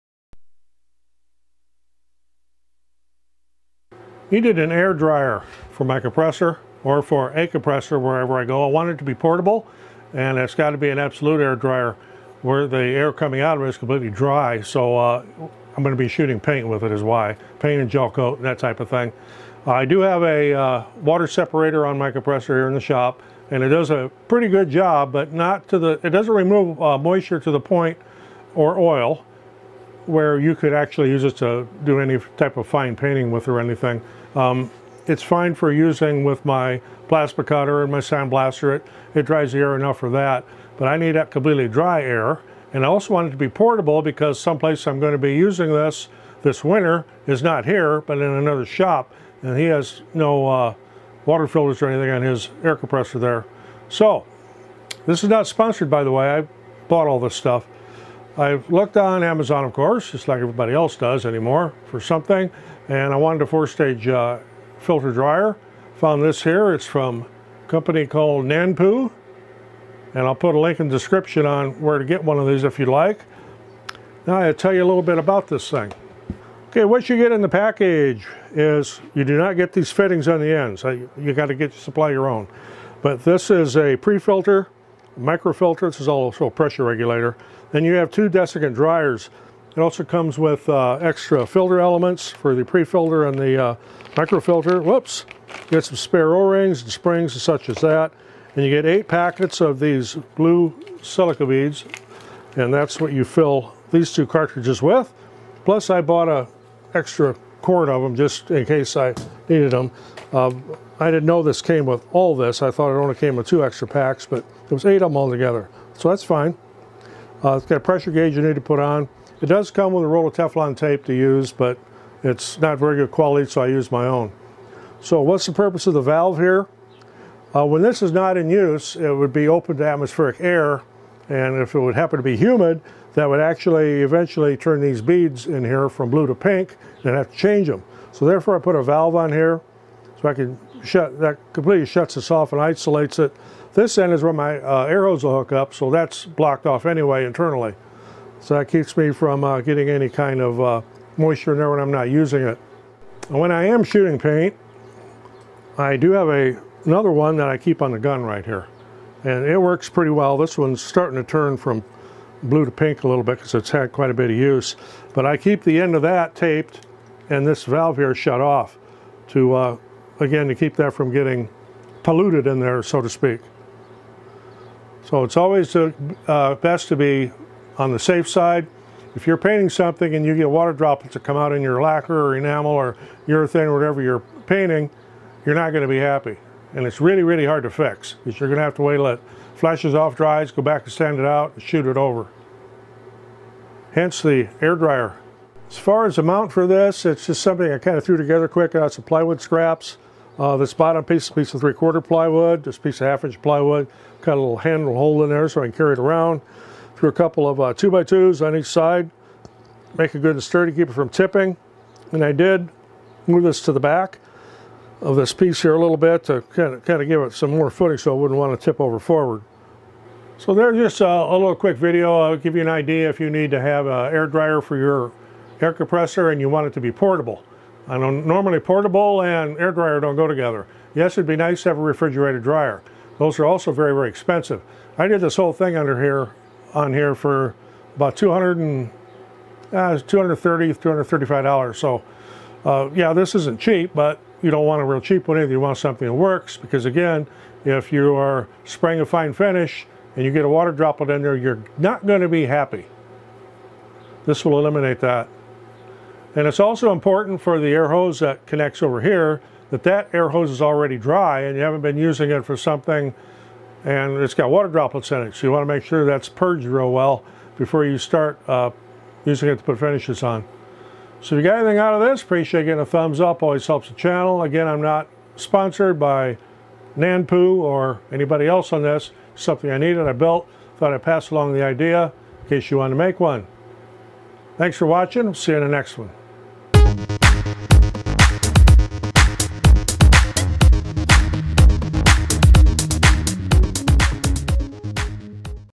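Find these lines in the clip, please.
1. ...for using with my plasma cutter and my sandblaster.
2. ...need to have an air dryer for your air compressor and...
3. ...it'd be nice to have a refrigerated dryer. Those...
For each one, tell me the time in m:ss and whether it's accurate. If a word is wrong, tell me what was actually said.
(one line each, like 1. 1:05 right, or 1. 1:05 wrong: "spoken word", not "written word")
1. 0:35 right
2. 3:43 right
3. 3:51 right.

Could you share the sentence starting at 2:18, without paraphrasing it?
So therefore I put a valve on here so I can shut, that completely shuts this off and isolates it.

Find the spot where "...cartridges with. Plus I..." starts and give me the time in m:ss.
1:44.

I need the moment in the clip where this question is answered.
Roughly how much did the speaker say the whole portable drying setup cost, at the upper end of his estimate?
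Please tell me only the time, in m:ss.
4:00.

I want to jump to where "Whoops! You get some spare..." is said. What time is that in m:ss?
1:34.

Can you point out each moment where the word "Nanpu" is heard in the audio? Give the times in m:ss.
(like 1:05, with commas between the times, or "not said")
1:08, 4:36.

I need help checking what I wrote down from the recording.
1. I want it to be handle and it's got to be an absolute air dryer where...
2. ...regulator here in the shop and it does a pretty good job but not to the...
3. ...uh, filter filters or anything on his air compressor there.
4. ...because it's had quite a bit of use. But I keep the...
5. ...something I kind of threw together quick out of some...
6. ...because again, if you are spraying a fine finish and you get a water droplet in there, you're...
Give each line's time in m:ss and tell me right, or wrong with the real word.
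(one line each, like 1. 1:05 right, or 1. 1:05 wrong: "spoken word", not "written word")
1. 0:08 wrong: "portable", not "handle"
2. 0:22 wrong: "compressor", not "regulator"
3. 0:50 wrong: "water", not "filter"
4. 2:43 right
5. 3:17 right
6. 4:06 right.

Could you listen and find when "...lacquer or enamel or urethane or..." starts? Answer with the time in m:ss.
3:01.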